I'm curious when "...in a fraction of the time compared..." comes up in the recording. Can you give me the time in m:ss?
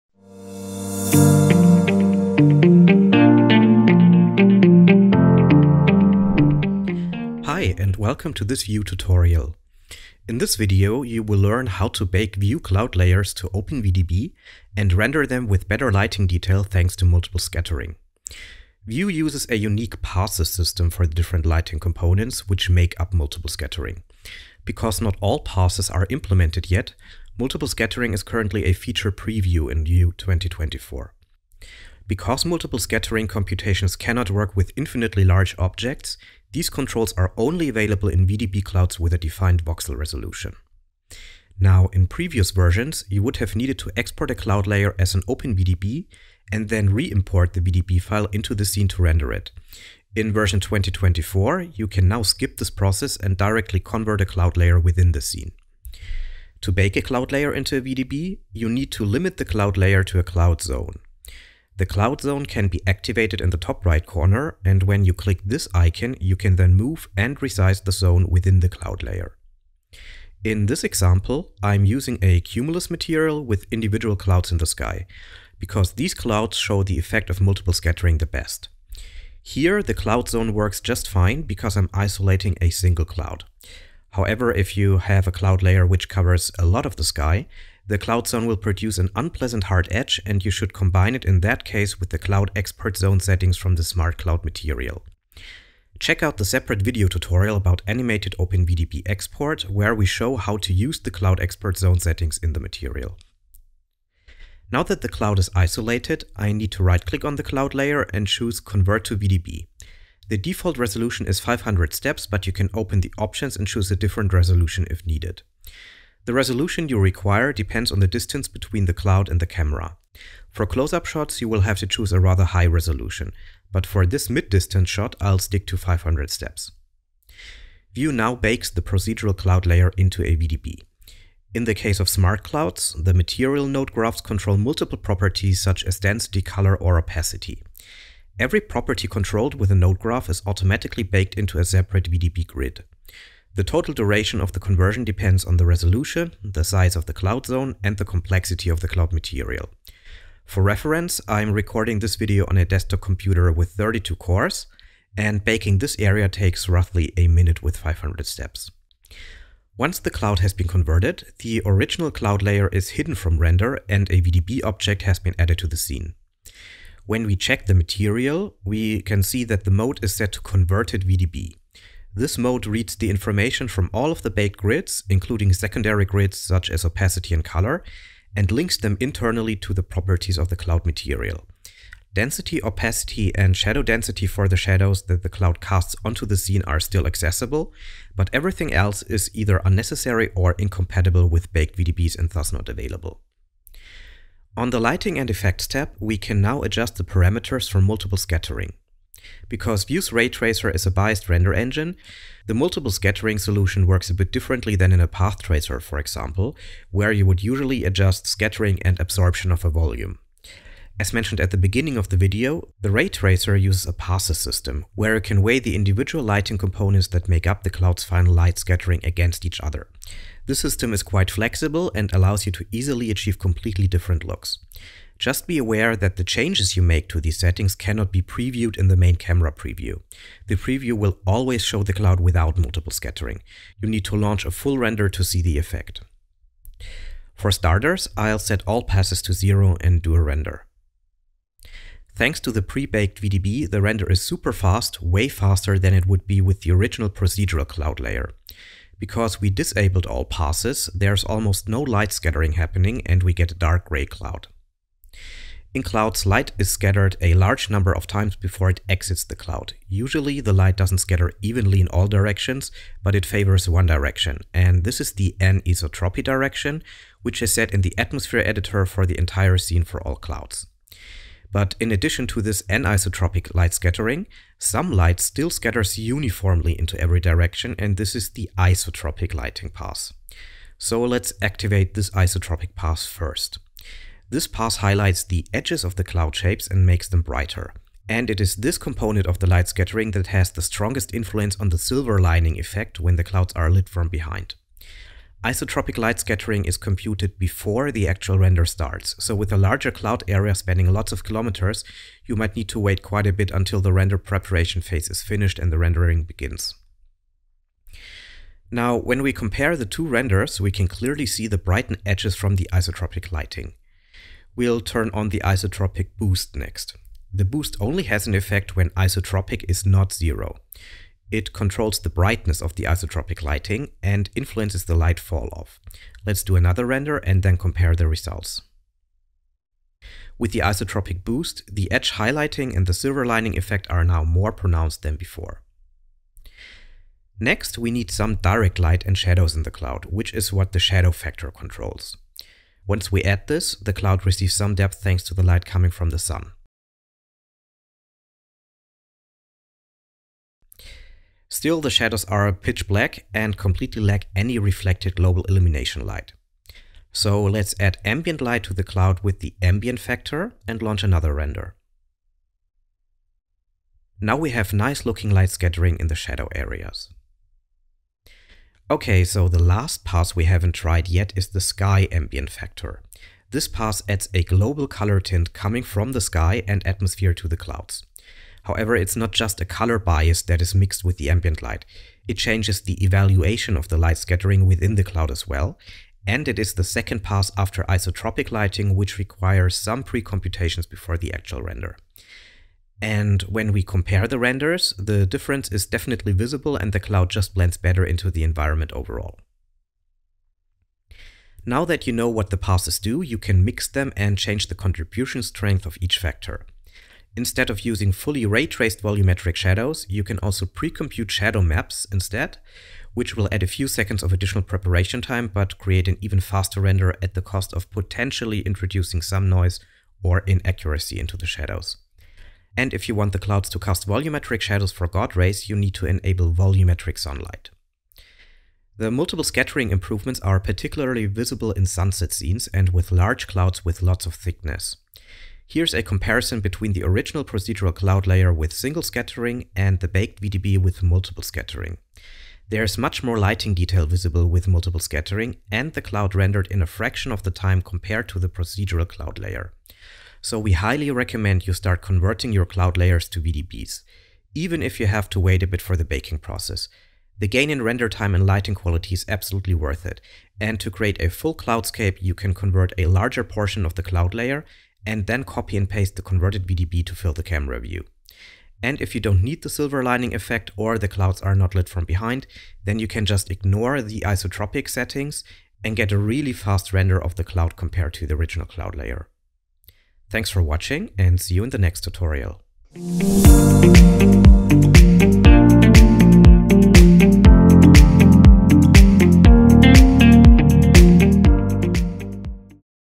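7:26.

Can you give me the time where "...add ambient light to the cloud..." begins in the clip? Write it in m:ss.
5:57.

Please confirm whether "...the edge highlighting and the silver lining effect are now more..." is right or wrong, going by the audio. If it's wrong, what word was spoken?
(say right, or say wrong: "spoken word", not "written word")
right.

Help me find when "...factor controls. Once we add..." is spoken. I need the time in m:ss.
5:41.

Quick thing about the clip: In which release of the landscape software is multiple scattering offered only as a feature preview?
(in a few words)
Vue 2024.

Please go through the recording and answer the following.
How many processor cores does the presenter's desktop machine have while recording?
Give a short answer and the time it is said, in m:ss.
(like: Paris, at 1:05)
32, at 2:33.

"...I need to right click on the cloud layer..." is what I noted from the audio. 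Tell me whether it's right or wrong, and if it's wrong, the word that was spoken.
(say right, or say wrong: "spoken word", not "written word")
right.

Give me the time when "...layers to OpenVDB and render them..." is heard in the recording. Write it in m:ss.
0:12.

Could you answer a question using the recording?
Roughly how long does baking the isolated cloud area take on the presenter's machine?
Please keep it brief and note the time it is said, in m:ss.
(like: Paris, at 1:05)
a minute, at 2:36.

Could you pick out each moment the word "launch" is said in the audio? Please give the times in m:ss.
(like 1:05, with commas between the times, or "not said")
3:54, 6:00.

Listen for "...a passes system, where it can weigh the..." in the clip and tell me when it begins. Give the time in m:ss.
3:33.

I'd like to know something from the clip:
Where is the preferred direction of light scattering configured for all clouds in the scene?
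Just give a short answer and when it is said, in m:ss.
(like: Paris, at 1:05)
atmosphere editor, at 4:27.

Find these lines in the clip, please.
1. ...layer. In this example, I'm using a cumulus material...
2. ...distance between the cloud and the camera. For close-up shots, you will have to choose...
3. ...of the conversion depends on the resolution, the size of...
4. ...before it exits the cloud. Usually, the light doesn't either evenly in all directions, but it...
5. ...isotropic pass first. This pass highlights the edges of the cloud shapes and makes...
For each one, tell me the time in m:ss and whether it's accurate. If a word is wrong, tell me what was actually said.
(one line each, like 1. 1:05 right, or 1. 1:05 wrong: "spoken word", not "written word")
1. 1:09 right
2. 1:58 right
3. 2:24 right
4. 4:18 wrong: "scatter", not "either"
5. 4:42 right.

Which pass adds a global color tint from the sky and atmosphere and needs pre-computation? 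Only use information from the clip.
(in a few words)
sky ambient factor.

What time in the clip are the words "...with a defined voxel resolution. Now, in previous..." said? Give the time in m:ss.
0:38.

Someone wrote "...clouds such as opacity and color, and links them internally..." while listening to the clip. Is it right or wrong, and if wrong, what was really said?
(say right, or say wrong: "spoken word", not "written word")
wrong: "grids", not "clouds".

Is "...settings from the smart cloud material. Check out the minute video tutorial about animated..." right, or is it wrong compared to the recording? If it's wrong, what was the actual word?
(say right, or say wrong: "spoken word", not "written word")
wrong: "separate", not "minute".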